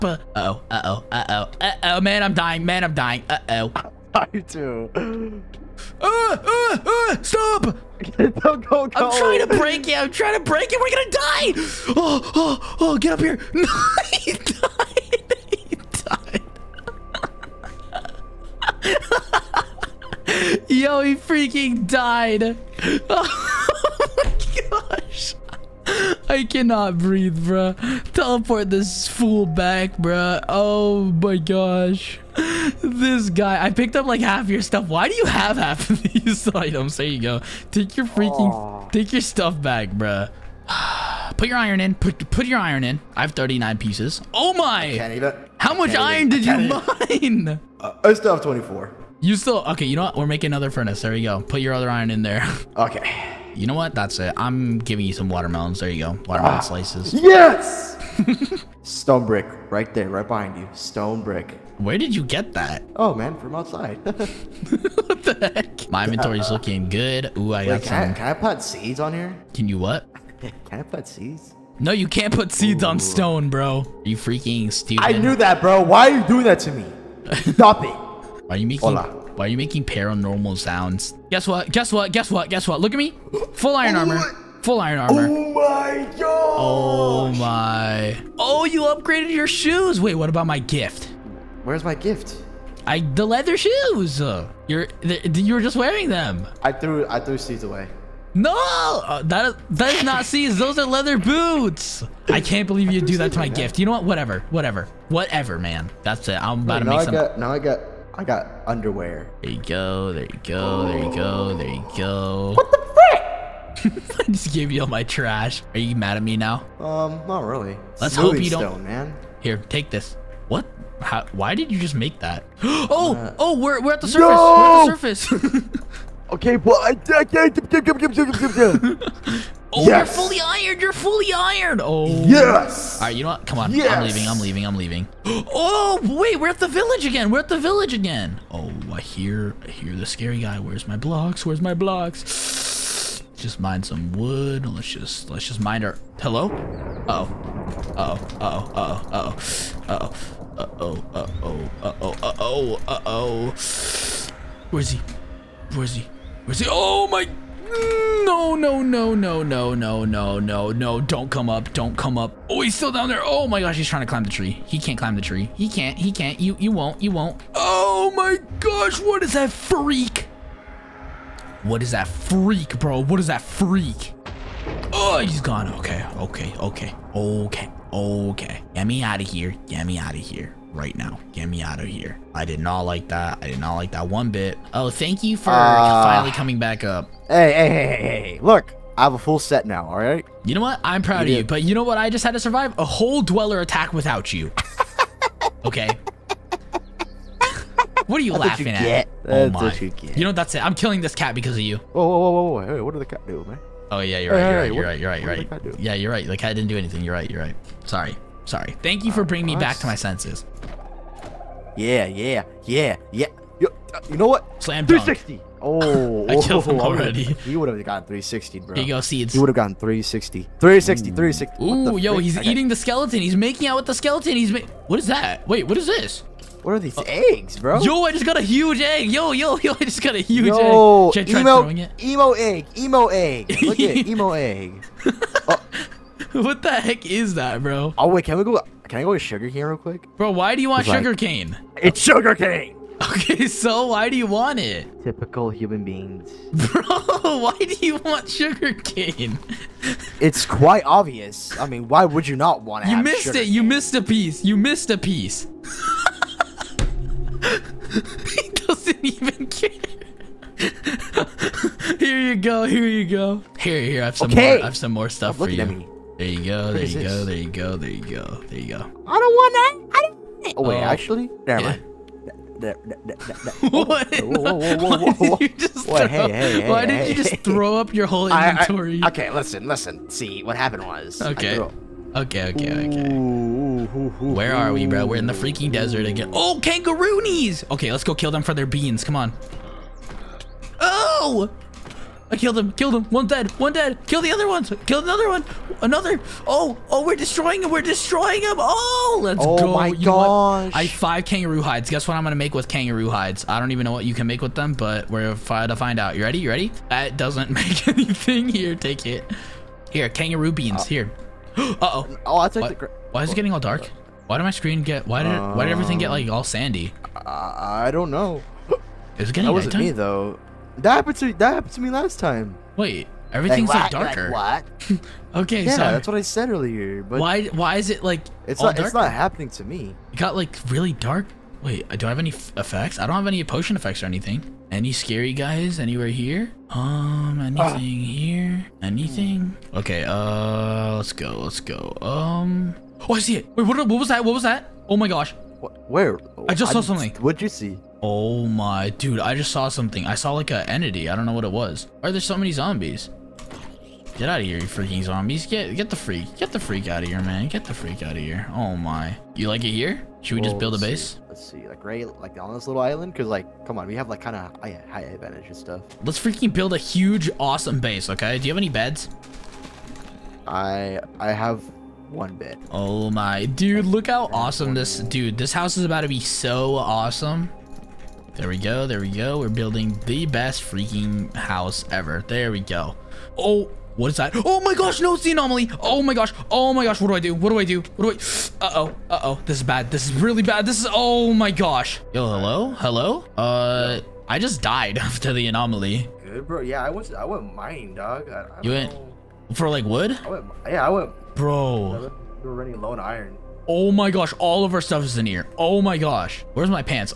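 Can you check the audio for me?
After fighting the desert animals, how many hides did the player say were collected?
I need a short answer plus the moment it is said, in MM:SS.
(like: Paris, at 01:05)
5, at 05:00.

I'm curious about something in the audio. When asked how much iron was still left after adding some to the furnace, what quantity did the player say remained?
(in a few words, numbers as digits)
24.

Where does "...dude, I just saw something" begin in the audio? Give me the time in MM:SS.
05:48.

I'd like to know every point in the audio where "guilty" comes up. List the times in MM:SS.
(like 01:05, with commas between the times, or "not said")
not said.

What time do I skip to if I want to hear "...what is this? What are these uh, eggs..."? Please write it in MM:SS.
03:45.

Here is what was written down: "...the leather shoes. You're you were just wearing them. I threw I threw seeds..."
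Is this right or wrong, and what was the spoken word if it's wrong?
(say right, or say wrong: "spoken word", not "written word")
right.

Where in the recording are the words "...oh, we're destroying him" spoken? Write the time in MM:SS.
04:56.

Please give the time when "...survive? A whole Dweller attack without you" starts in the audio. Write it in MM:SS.
03:12.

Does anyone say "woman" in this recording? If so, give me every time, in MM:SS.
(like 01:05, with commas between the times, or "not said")
not said.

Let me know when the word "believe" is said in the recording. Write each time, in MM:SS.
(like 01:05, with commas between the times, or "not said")
01:42.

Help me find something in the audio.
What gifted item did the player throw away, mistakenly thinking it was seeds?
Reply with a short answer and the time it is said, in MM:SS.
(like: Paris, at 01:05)
Leather boots, at 01:40.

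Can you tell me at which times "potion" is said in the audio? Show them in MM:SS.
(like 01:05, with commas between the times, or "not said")
05:33.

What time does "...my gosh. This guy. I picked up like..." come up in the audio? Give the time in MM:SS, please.
00:31.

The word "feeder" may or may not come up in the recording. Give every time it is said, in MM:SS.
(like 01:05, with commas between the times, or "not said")
not said.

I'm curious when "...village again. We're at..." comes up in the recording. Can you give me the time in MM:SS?
02:16.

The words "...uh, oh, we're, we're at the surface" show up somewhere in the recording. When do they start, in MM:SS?
02:03.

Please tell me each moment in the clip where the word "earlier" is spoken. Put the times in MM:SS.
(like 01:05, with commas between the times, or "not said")
05:26.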